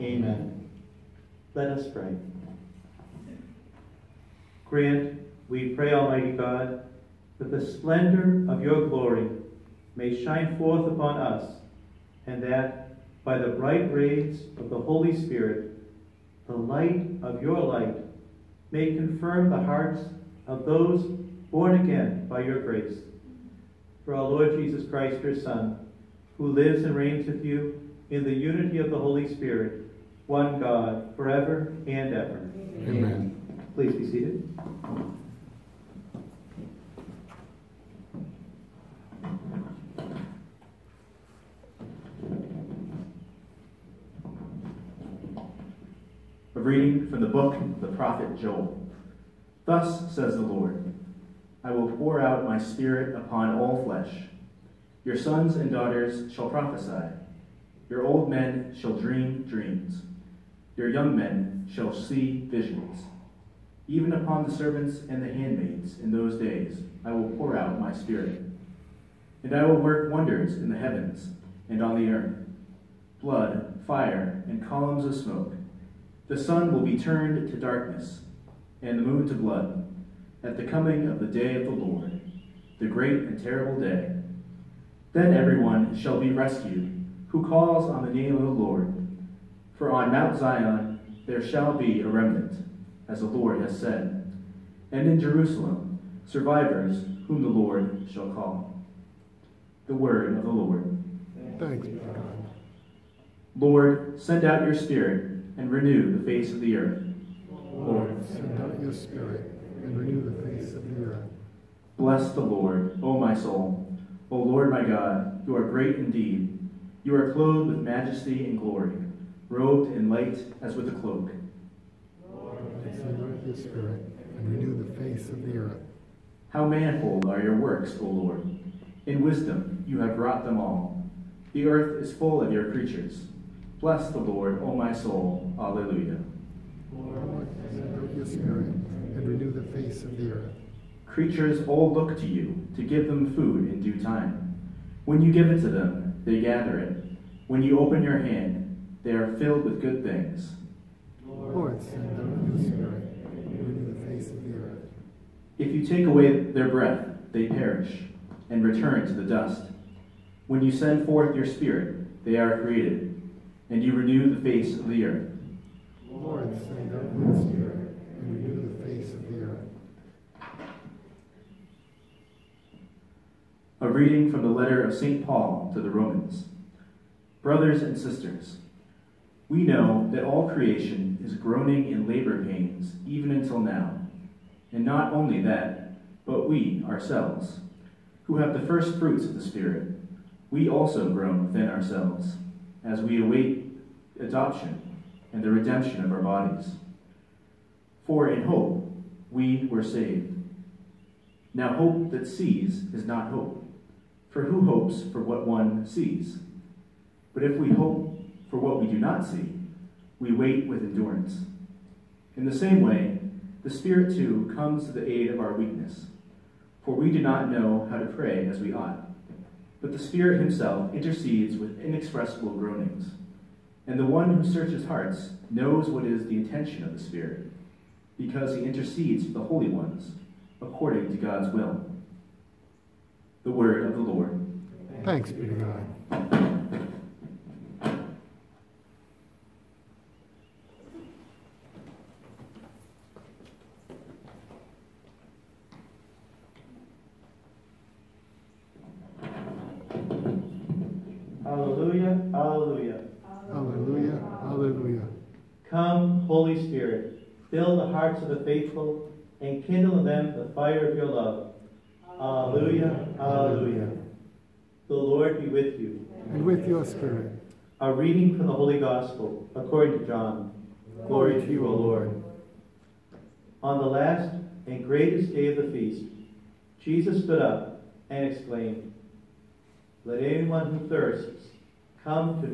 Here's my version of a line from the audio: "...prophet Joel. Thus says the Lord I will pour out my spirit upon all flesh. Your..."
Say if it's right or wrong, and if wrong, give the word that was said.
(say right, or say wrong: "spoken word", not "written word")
right.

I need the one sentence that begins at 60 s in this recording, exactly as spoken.
Your young men shall see visions.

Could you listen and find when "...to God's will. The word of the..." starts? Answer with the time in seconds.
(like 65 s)
231 s.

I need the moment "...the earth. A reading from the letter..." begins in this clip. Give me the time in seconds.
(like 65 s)
169 s.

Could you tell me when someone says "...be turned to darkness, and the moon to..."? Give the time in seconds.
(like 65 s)
76 s.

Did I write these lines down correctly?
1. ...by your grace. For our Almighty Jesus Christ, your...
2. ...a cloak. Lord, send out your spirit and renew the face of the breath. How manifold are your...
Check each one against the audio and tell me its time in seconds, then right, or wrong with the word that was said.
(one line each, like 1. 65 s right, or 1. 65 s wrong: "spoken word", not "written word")
1. 22 s wrong: "Lord", not "Almighty"
2. 120 s wrong: "earth", not "breath".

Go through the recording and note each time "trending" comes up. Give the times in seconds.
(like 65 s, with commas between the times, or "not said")
not said.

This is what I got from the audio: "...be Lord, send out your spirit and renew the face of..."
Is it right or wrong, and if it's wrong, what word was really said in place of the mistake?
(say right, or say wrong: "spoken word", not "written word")
right.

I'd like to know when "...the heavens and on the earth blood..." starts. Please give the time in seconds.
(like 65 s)
70 s.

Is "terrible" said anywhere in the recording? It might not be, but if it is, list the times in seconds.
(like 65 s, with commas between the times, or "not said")
83 s.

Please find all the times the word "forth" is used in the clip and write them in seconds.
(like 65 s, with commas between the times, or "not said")
10 s, 161 s.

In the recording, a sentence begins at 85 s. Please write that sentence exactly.
Then everyone shall be rescued who calls on the name of the Lord.